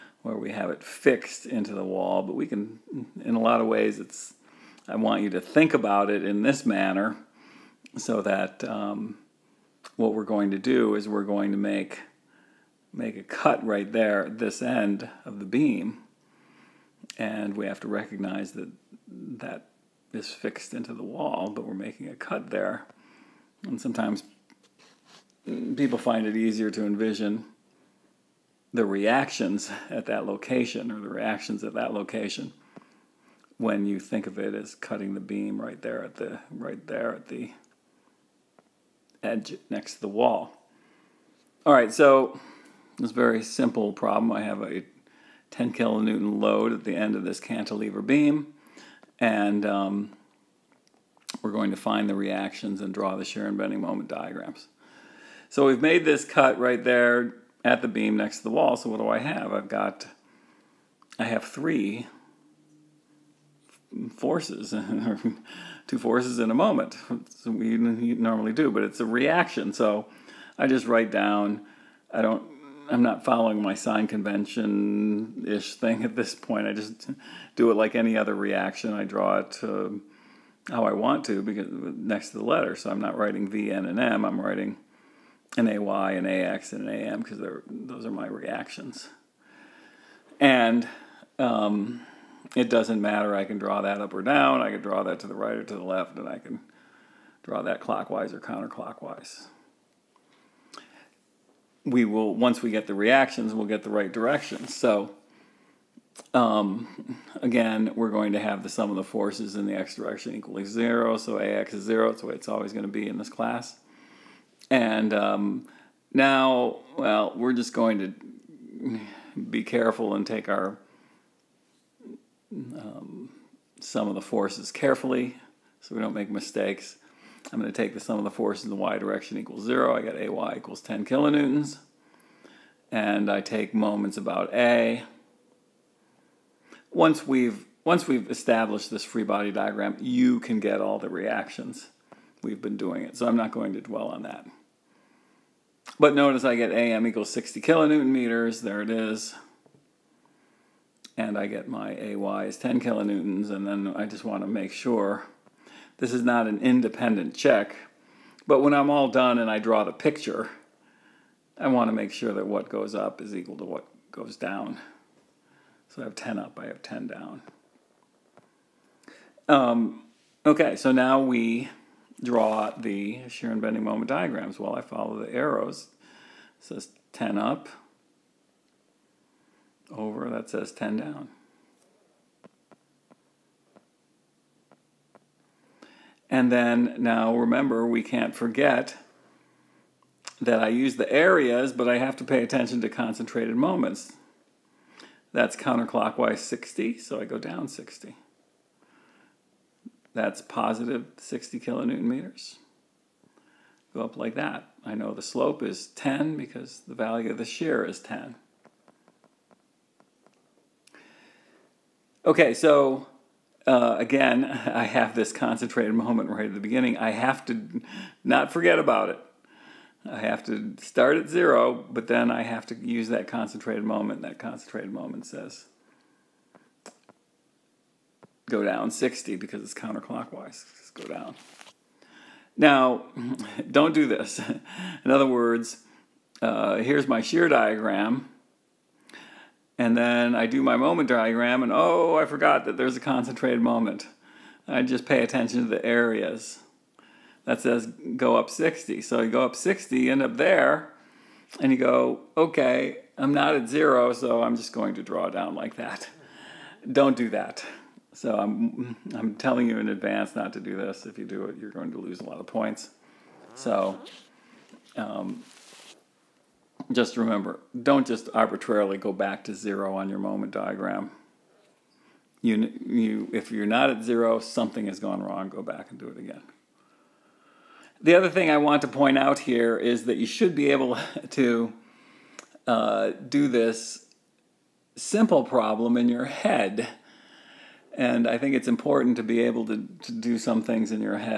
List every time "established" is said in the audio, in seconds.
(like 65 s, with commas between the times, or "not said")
138 s.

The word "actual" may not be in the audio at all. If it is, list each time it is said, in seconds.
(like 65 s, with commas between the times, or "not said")
not said.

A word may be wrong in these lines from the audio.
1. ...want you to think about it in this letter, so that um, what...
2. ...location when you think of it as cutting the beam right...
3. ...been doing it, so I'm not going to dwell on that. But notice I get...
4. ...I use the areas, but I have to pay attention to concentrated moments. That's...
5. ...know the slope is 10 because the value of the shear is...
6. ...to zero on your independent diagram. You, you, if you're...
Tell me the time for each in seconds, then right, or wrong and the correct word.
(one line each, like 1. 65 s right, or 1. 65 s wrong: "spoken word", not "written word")
1. 4 s wrong: "manner", not "letter"
2. 31 s right
3. 142 s right
4. 190 s right
5. 204 s right
6. 269 s wrong: "moment", not "independent".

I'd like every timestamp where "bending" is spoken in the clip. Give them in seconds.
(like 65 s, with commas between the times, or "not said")
53 s, 173 s.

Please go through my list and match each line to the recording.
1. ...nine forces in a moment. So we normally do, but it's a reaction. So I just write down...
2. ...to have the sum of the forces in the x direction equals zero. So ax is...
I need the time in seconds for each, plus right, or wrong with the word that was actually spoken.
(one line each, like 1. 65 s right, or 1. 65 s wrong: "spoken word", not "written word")
1. 65 s wrong: "two", not "nine"
2. 108 s right.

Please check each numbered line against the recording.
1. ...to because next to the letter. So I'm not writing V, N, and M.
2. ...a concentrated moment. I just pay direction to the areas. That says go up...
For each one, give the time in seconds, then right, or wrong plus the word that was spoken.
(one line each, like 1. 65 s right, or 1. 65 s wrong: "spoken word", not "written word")
1. 81 s right
2. 242 s wrong: "attention", not "direction".